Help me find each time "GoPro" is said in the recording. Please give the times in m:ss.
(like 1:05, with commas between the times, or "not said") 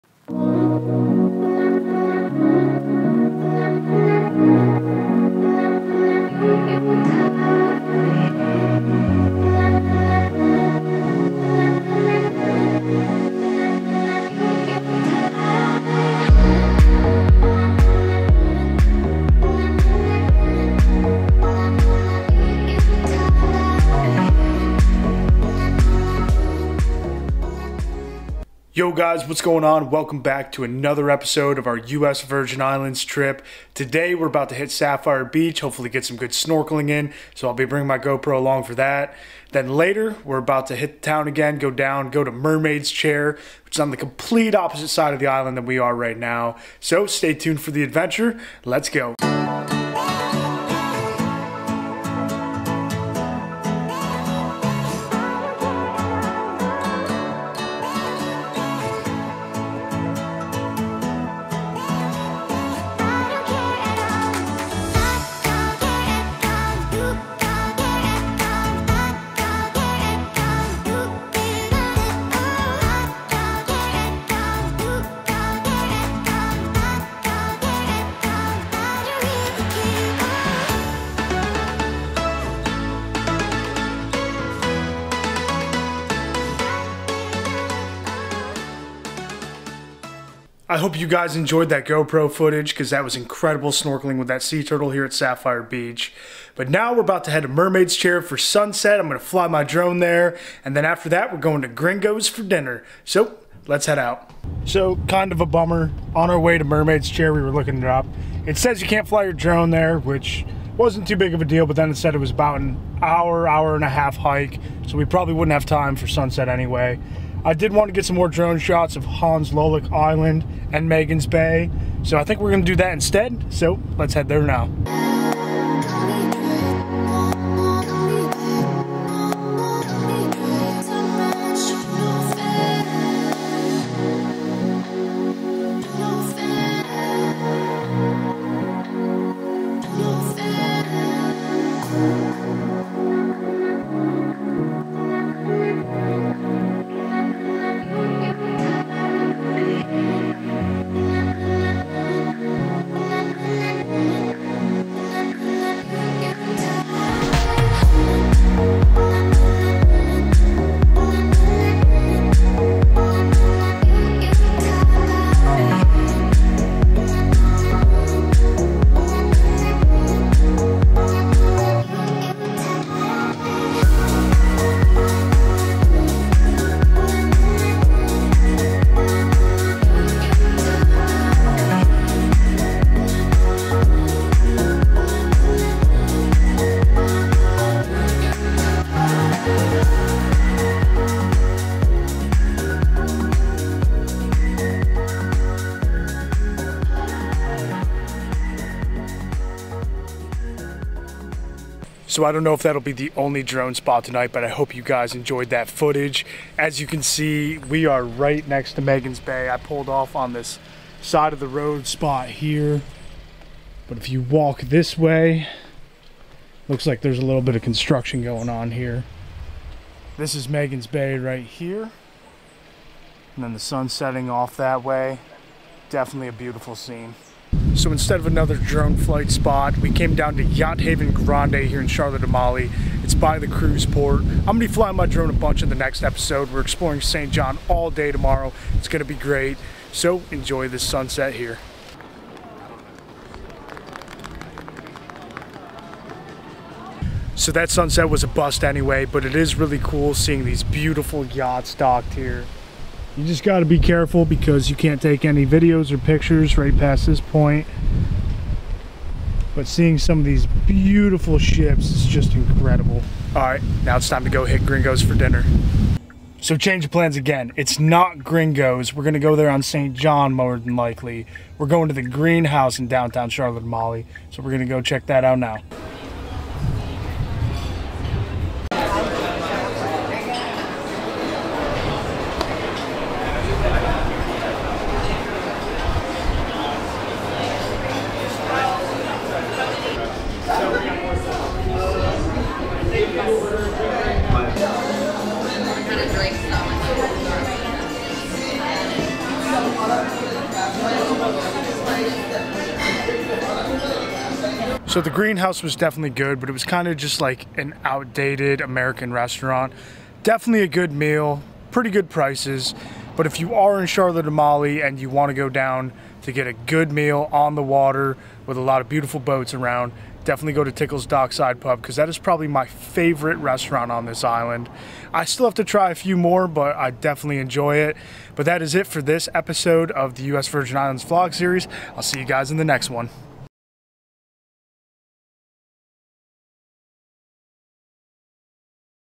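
0:37, 1:31.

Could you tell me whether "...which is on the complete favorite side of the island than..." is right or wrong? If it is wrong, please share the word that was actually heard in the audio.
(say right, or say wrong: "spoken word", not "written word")
wrong: "opposite", not "favorite".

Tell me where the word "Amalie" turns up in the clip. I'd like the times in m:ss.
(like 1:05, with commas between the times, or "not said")
3:52, 4:33, 5:14.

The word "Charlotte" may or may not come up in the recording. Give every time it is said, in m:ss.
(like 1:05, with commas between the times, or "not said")
3:51, 4:33, 5:13.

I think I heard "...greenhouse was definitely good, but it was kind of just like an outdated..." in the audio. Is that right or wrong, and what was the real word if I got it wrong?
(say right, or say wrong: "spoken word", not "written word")
right.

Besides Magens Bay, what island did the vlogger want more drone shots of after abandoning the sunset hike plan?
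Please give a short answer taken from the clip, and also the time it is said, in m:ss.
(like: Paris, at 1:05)
Hans Lollik Island, at 1:59.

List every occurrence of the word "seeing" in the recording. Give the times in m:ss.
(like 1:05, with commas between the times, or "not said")
4:10, 4:19.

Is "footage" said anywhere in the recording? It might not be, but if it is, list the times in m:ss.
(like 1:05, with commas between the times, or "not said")
1:32, 3:25.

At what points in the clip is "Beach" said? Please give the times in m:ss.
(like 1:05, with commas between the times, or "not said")
0:35, 1:35.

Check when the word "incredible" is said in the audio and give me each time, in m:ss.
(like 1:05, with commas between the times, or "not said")
1:33, 4:22.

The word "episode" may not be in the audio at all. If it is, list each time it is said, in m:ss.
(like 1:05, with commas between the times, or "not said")
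0:31, 3:56, 5:29.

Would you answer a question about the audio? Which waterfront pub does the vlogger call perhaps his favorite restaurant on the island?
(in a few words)
Tickle's Dockside Pub.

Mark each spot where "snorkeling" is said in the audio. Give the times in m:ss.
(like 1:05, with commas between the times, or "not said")
0:36, 1:33.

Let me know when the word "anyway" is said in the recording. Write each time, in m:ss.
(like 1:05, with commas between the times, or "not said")
1:56, 4:08.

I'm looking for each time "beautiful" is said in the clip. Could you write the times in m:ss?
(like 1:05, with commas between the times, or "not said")
3:46, 4:10, 4:20, 5:18.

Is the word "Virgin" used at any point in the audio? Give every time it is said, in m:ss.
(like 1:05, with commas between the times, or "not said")
0:32, 5:30.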